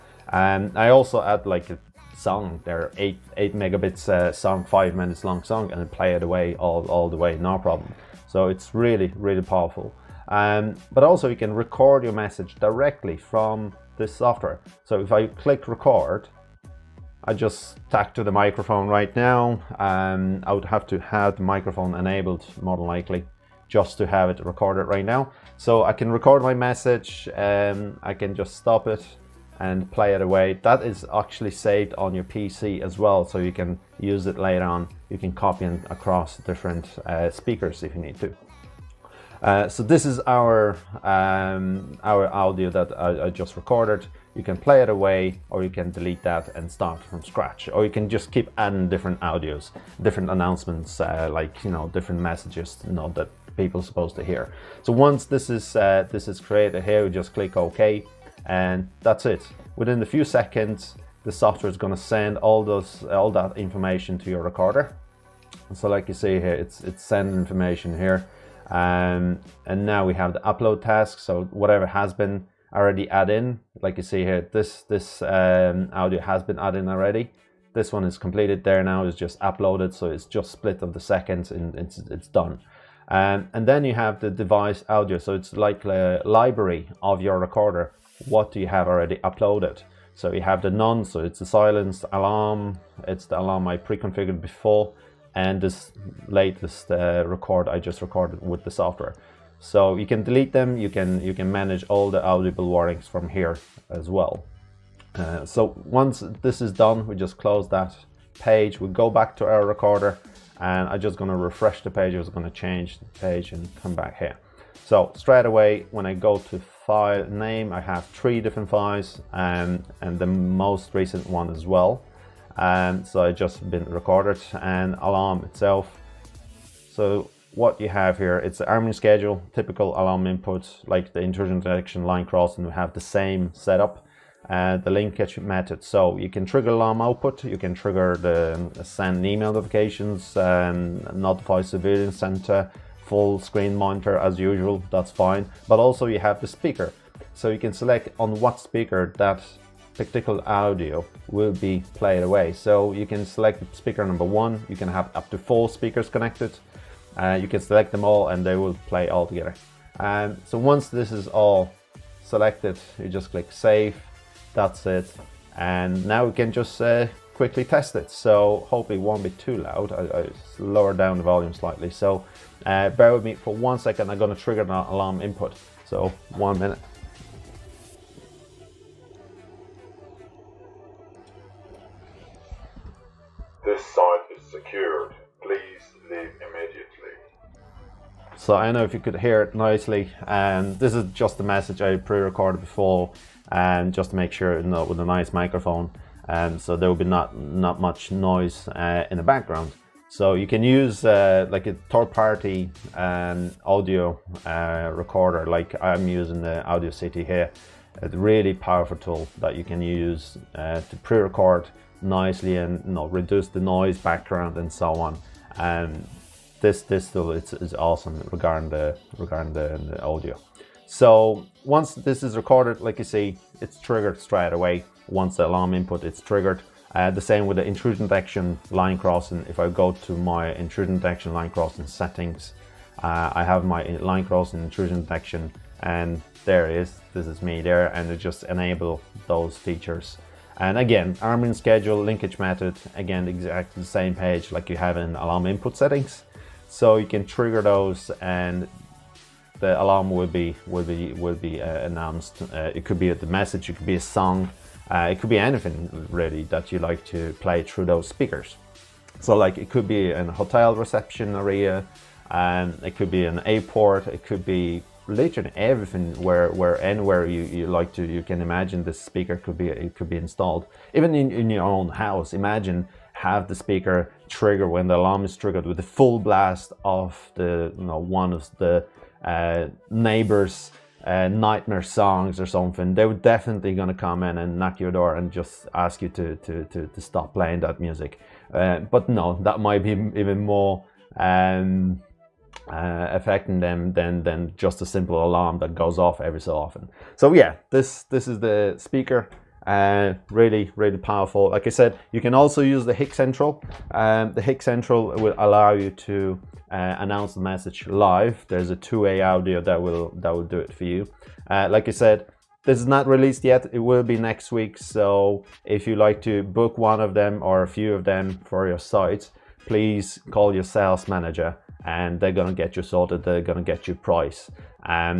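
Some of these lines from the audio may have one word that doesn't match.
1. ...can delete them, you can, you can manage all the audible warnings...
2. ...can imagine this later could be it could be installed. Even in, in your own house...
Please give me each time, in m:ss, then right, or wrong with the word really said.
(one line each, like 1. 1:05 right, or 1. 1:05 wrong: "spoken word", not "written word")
1. 1:40 right
2. 4:28 wrong: "speaker", not "later".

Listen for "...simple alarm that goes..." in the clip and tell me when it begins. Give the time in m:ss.
4:54.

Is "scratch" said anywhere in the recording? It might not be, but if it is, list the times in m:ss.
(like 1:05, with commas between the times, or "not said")
0:47.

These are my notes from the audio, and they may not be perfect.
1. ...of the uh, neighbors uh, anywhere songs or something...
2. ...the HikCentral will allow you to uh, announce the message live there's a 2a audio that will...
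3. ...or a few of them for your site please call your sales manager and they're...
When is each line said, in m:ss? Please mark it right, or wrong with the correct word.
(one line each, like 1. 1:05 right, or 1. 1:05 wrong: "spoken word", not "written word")
1. 4:38 wrong: "nightmare", not "anywhere"
2. 5:04 right
3. 5:17 right.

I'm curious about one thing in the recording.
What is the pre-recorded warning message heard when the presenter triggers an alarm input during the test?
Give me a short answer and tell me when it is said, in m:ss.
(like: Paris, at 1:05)
This site is secured. Please leave immediately., at 3:03.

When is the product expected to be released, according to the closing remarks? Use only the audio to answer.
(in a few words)
next week.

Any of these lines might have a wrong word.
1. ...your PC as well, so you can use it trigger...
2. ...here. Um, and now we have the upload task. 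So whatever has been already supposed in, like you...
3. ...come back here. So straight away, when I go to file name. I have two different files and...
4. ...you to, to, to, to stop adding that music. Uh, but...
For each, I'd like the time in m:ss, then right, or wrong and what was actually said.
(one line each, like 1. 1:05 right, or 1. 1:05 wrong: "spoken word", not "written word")
1. 0:32 wrong: "later", not "trigger"
2. 1:07 wrong: "added", not "supposed"
3. 1:53 wrong: "three", not "two"
4. 4:46 wrong: "playing", not "adding".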